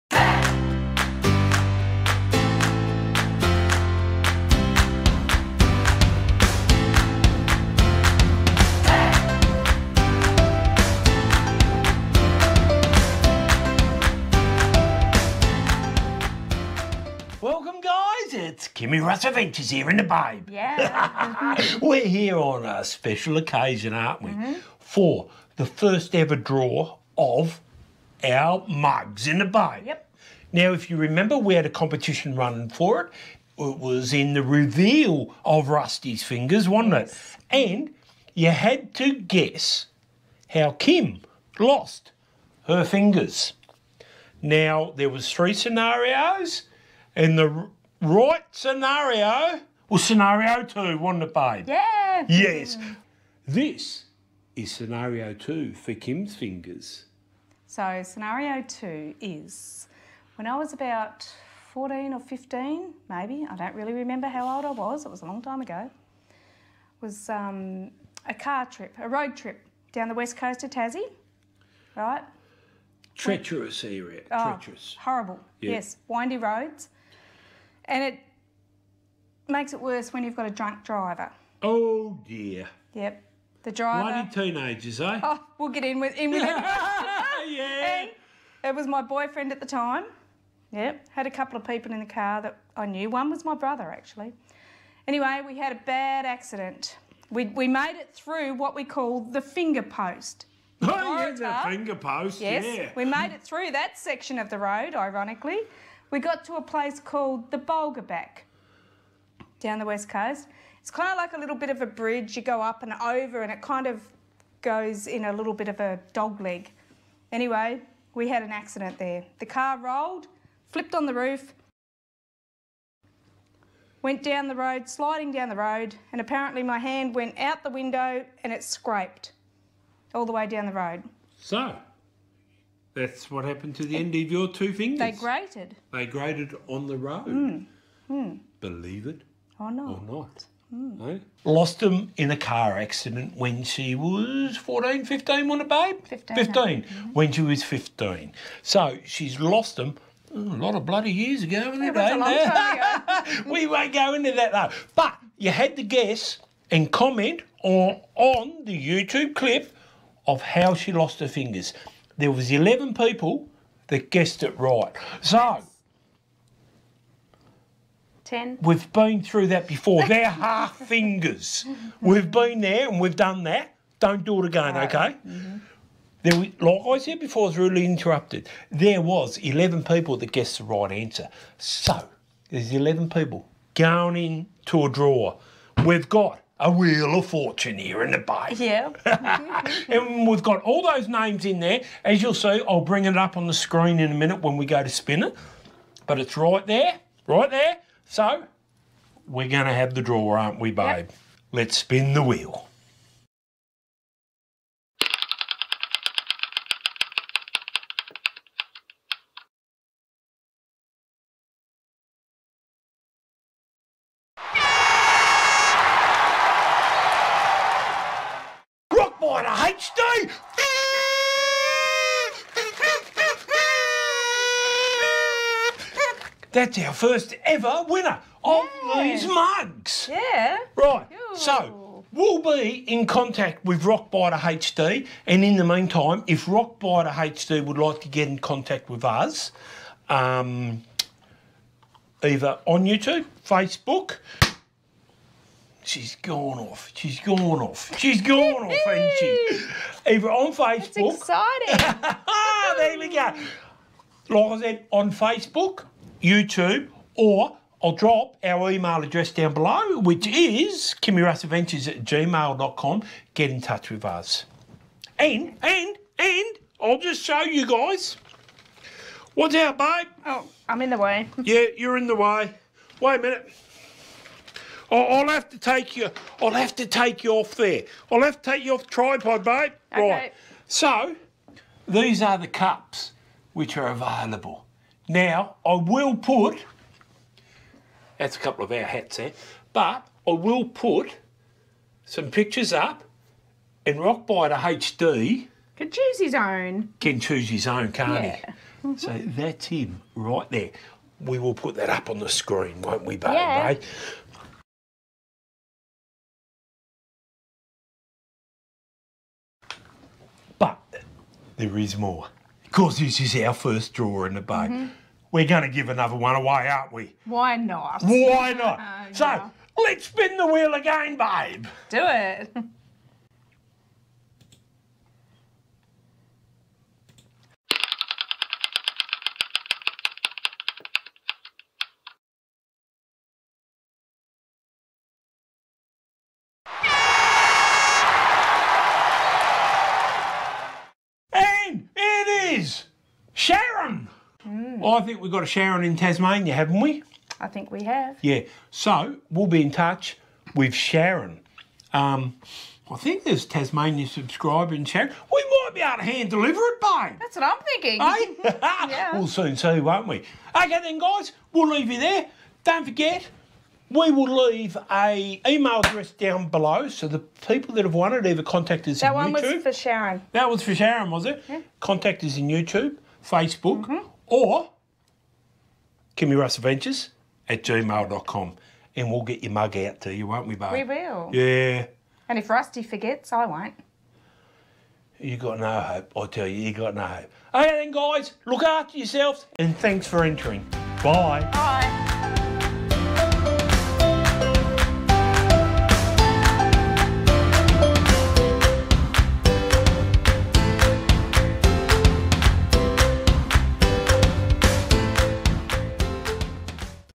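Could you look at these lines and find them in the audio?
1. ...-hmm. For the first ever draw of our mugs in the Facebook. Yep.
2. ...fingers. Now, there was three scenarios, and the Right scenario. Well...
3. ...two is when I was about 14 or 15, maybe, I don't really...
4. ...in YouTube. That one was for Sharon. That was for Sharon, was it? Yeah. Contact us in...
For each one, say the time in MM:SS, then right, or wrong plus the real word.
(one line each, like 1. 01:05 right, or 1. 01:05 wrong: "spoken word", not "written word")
1. 00:24 wrong: "Bay", not "Facebook"
2. 00:42 right
3. 00:58 right
4. 06:09 right.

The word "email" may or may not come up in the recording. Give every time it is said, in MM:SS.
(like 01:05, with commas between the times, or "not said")
04:18, 06:05.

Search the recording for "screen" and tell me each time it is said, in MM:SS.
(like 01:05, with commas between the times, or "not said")
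03:13, 05:02.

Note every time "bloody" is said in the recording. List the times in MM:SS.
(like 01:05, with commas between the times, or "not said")
02:30.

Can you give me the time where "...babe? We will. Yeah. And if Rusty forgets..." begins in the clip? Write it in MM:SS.
06:20.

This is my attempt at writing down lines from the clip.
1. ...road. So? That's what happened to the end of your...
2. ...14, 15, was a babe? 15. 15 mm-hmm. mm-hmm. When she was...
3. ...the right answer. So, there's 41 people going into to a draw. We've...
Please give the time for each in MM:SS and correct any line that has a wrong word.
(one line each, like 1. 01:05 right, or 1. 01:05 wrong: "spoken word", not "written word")
1. 02:10 right
2. 02:24 right
3. 03:00 wrong: "11", not "41".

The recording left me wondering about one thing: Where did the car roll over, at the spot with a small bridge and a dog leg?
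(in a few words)
Bulgobac.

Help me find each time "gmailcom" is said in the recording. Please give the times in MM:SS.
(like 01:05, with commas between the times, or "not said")
04:22, 06:17.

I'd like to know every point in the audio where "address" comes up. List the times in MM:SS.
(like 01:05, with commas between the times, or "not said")
04:19, 06:05.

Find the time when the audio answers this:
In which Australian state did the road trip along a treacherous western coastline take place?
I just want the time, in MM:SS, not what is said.
01:10.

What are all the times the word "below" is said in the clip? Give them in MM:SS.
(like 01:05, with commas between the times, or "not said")
04:19, 06:06.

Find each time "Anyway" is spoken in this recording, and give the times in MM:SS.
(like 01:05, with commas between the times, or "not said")
01:35, 01:57.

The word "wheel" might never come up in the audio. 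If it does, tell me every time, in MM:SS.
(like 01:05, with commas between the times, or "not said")
03:06, 03:22, 05:20.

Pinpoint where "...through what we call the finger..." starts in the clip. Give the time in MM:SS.
01:38.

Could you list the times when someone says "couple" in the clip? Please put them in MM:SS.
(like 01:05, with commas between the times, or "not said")
01:31, 04:48.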